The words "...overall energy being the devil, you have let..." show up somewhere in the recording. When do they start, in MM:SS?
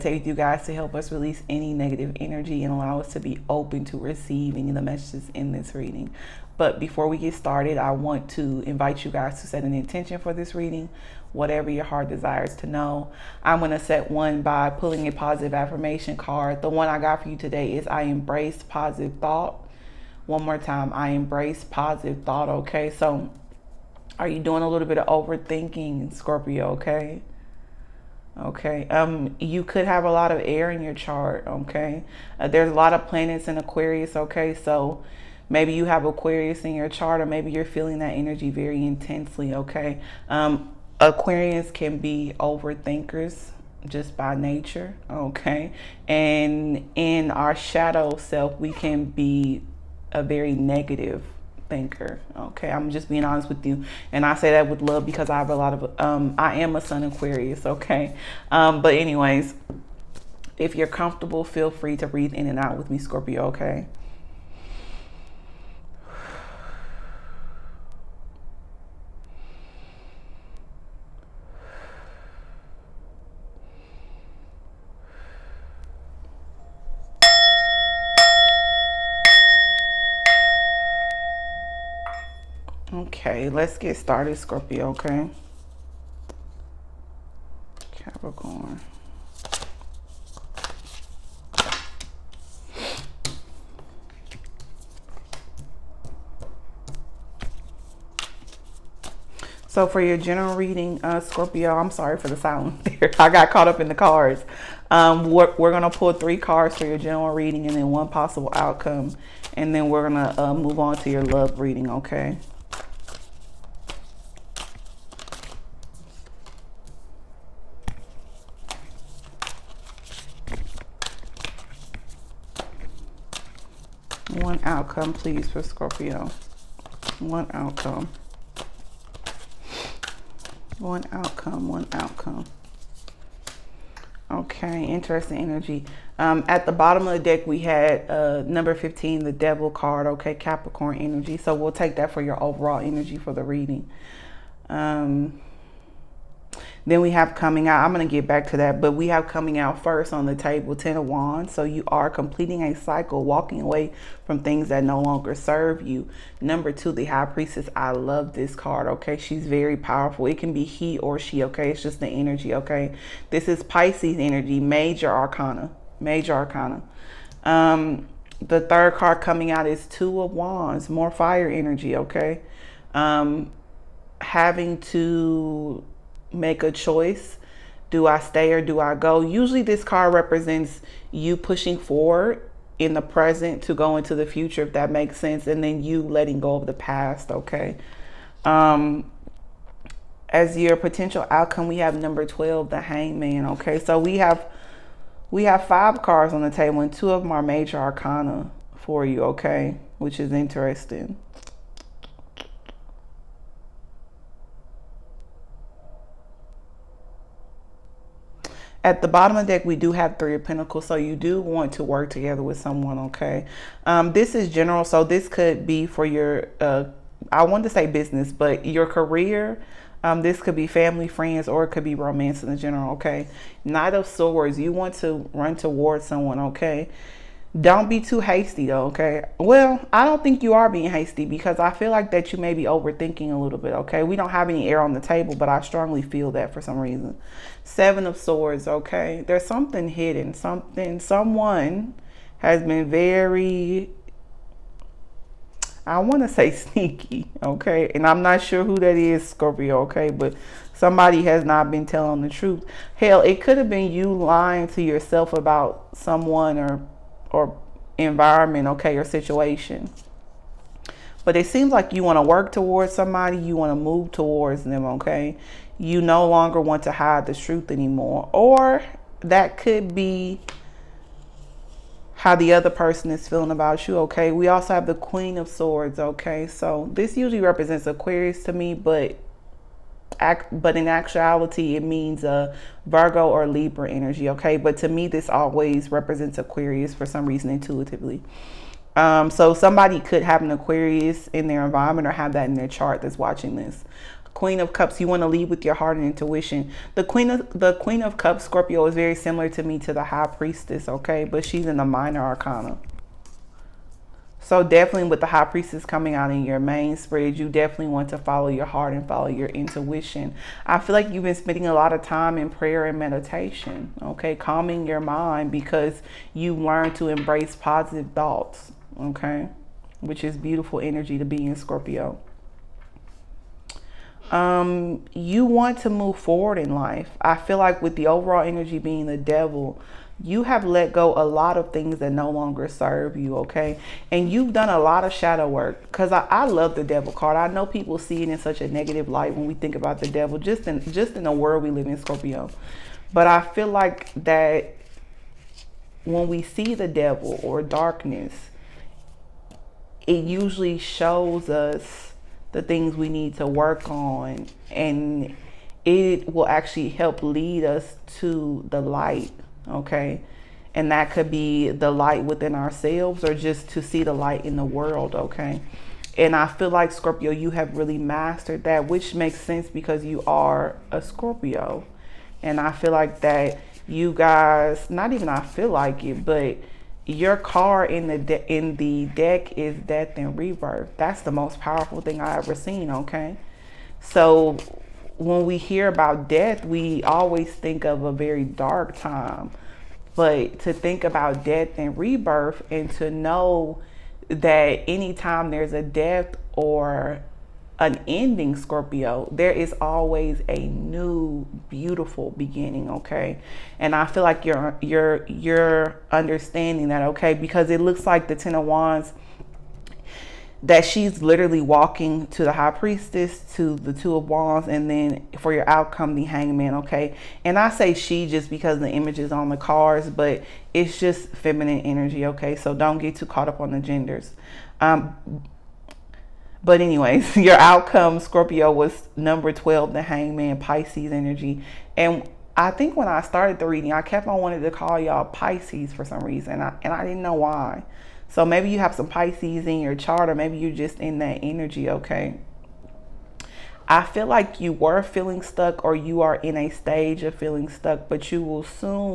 05:28.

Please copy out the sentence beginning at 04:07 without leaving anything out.
And I'm not sure who that is, Scorpio, okay?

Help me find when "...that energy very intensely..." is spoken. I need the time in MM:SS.
00:37.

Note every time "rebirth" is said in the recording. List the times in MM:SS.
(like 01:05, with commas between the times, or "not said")
06:20, 06:31.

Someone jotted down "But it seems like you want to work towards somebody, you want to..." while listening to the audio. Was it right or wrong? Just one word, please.
right.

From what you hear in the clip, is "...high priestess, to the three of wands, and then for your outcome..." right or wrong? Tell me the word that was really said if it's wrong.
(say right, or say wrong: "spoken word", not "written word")
wrong: "two", not "three".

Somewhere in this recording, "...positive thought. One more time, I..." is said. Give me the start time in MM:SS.
00:18.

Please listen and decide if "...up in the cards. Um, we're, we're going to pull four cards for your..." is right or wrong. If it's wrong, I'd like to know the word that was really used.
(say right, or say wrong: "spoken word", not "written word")
wrong: "three", not "four".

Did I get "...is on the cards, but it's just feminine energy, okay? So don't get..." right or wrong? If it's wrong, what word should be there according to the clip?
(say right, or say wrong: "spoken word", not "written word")
right.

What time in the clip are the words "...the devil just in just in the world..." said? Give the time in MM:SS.
05:40.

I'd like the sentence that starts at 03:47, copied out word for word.
Don't be too hasty though, okay?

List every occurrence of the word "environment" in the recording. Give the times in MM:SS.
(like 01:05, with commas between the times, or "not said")
04:17, 04:51.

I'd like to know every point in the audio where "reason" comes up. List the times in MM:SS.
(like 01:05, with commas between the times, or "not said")
03:56, 04:47, 07:16.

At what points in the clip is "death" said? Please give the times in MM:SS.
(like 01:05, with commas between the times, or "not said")
06:19, 06:26, 06:31, 06:35.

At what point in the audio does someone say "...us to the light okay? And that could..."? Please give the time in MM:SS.
05:57.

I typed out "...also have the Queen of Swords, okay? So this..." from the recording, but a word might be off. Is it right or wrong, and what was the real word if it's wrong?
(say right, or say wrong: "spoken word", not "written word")
right.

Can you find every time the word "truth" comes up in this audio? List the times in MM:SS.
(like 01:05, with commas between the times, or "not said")
04:12, 04:27.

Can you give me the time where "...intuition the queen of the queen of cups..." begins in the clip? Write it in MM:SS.
04:56.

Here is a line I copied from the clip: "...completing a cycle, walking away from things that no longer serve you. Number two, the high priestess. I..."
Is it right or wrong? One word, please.
right.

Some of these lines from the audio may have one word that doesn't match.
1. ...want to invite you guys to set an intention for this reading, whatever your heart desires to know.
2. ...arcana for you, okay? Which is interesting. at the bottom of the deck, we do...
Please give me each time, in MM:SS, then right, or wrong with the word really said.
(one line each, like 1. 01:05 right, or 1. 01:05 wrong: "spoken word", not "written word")
1. 00:07 right
2. 03:17 right.